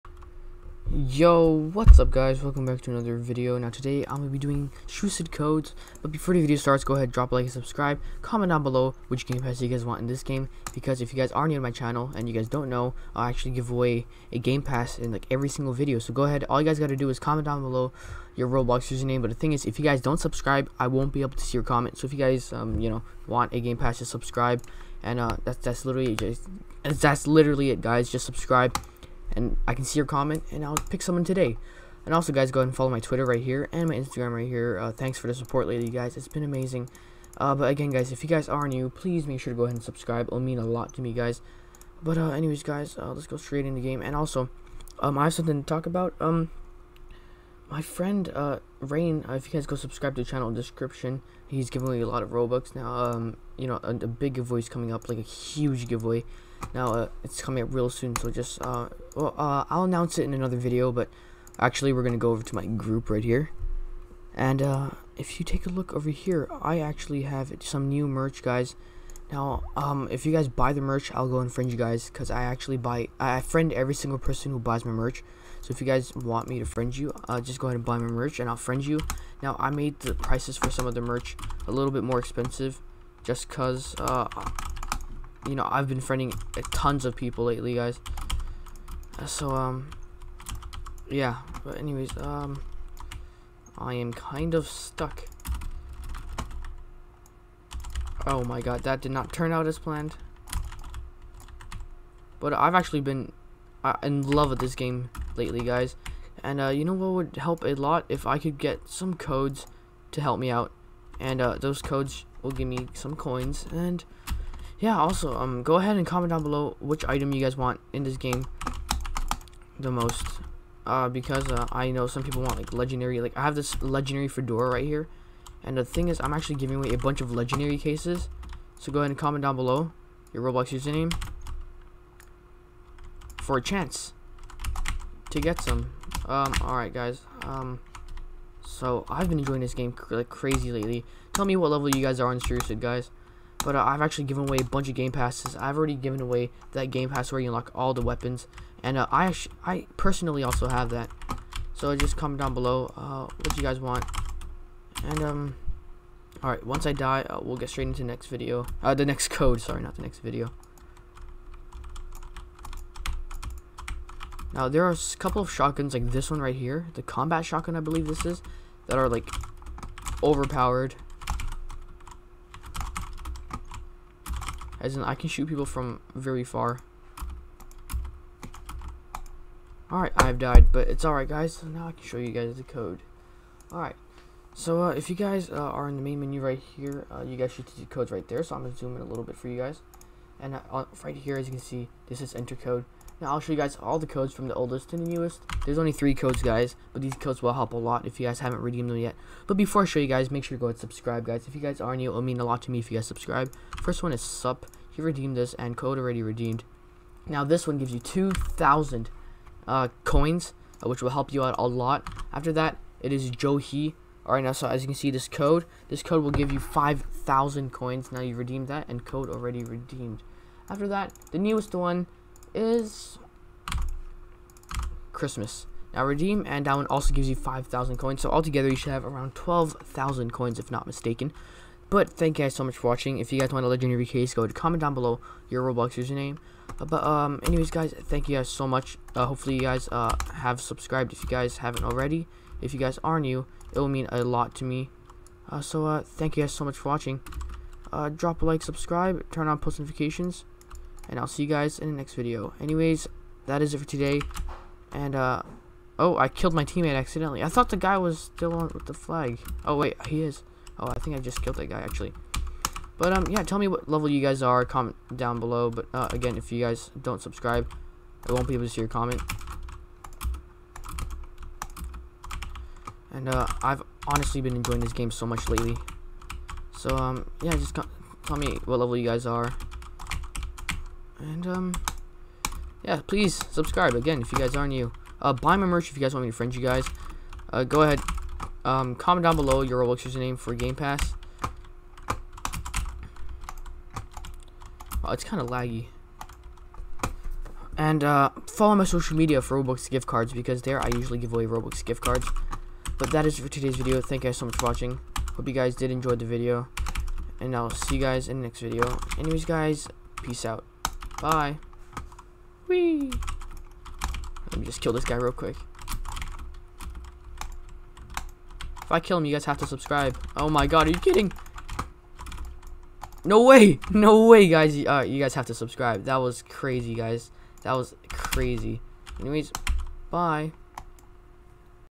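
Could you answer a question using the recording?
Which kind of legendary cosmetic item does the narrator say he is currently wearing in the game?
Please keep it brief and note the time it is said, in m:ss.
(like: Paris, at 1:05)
fedora, at 2:04.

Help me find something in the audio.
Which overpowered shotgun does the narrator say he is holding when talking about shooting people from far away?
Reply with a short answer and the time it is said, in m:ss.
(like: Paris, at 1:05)
combat shotgun, at 2:47.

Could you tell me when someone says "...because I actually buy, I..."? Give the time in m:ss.
1:12.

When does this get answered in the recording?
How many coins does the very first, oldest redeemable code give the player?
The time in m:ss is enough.
3:27.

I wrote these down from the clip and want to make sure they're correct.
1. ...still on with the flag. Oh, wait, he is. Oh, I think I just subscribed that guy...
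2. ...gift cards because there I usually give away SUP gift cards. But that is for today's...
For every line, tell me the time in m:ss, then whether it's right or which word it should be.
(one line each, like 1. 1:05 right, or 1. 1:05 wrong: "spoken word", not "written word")
1. 4:18 wrong: "killed", not "subscribed"
2. 4:59 wrong: "Roblox", not "SUP".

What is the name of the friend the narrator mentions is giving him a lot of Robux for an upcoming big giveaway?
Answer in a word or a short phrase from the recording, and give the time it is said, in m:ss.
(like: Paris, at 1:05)
Rain, at 0:48.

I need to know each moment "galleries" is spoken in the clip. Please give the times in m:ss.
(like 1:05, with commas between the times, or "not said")
not said.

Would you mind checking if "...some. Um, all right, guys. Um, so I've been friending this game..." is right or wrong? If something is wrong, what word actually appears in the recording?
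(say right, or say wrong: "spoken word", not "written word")
wrong: "enjoying", not "friending".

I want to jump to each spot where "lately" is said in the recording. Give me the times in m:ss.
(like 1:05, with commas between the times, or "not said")
0:35, 1:27, 1:45, 2:20, 4:35.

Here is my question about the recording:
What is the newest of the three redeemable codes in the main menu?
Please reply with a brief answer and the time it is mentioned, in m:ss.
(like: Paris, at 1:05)
Christmas, at 3:45.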